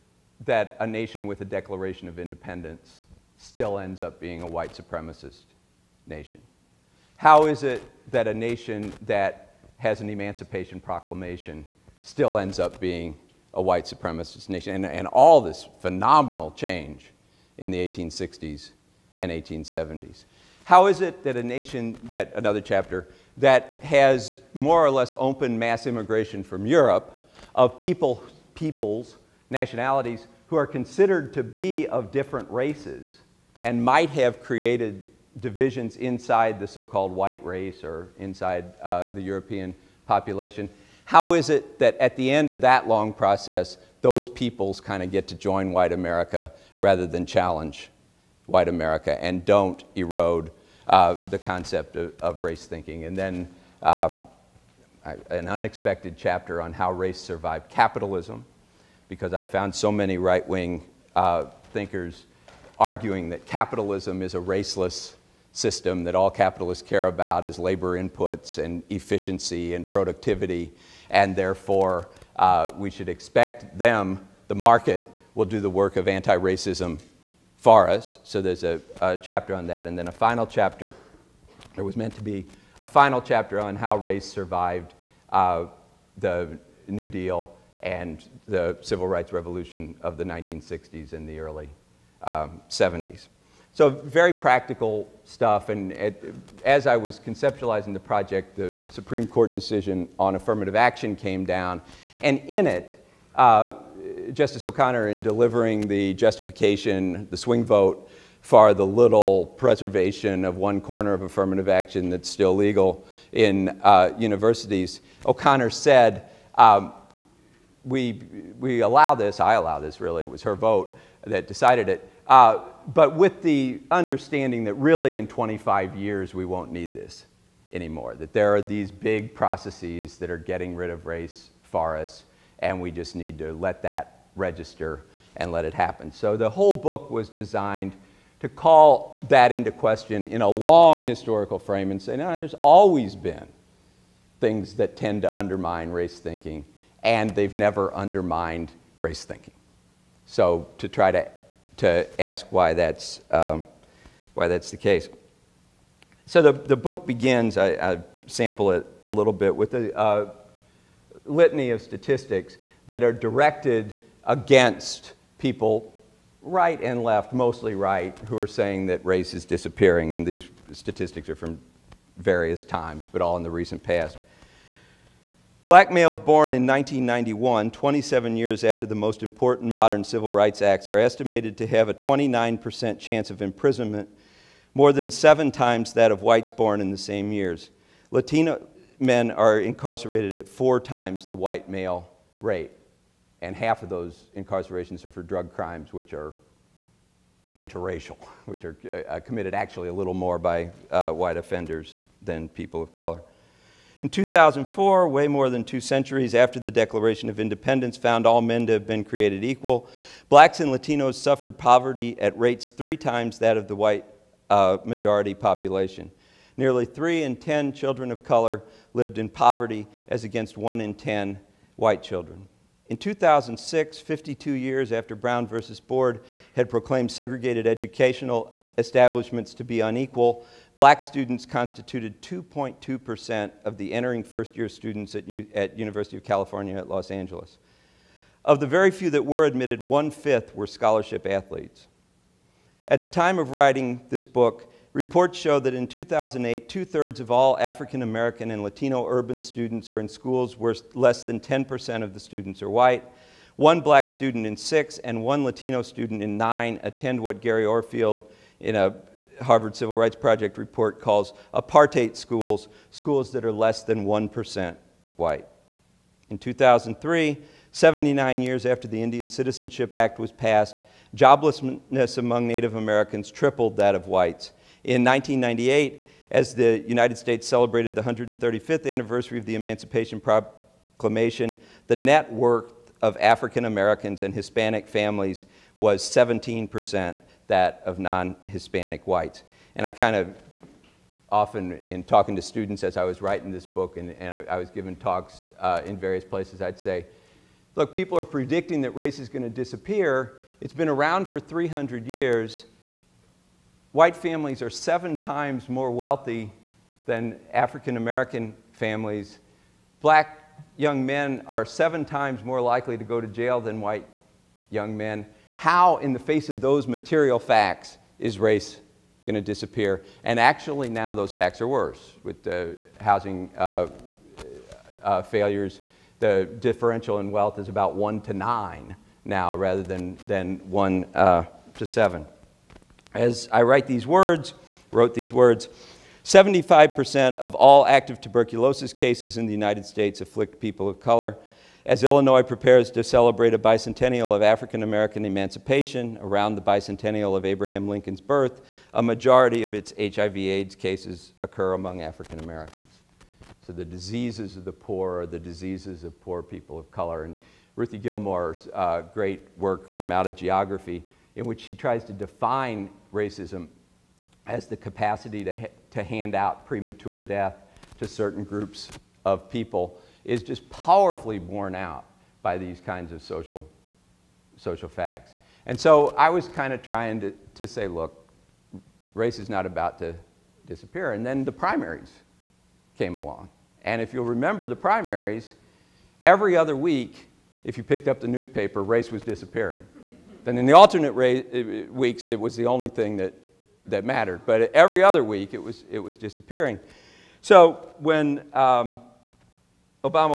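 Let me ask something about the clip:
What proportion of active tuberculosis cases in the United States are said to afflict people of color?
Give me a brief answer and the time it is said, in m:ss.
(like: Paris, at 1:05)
75%, at 5:36.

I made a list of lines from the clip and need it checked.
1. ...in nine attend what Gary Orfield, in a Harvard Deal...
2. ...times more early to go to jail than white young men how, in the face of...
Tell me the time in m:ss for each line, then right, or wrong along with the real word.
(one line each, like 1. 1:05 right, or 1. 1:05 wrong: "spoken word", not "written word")
1. 4:16 wrong: "Civil", not "Deal"
2. 5:12 wrong: "likely", not "early".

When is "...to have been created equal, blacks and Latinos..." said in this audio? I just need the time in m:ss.
3:28.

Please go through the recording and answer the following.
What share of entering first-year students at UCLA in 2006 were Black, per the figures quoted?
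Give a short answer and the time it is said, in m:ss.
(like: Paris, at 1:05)
2.2%, at 3:52.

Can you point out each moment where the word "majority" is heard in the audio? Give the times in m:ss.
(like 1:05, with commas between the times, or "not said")
3:34, 5:49.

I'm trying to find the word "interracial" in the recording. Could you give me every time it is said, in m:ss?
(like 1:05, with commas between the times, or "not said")
3:17.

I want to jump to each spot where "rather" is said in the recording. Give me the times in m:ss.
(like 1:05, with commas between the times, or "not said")
0:46, 5:29.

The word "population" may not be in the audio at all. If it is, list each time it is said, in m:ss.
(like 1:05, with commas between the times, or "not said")
0:40, 3:35.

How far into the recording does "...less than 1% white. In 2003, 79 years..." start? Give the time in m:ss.
4:23.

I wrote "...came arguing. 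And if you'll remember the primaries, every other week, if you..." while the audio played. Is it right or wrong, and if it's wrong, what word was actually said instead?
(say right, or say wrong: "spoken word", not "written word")
wrong: "along", not "arguing".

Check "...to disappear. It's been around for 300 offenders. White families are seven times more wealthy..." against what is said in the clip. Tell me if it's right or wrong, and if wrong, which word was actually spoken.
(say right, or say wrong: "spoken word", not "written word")
wrong: "years", not "offenders".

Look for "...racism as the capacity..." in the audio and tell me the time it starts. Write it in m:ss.
6:03.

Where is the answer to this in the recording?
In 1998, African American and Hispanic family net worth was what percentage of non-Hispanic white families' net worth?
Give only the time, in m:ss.
4:46.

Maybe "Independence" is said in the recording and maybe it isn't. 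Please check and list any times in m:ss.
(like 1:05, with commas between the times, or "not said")
0:02, 3:27.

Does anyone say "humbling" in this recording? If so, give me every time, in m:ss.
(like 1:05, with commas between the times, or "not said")
not said.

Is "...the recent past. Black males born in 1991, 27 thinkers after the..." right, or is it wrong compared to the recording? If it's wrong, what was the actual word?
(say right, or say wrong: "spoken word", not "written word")
wrong: "years", not "thinkers".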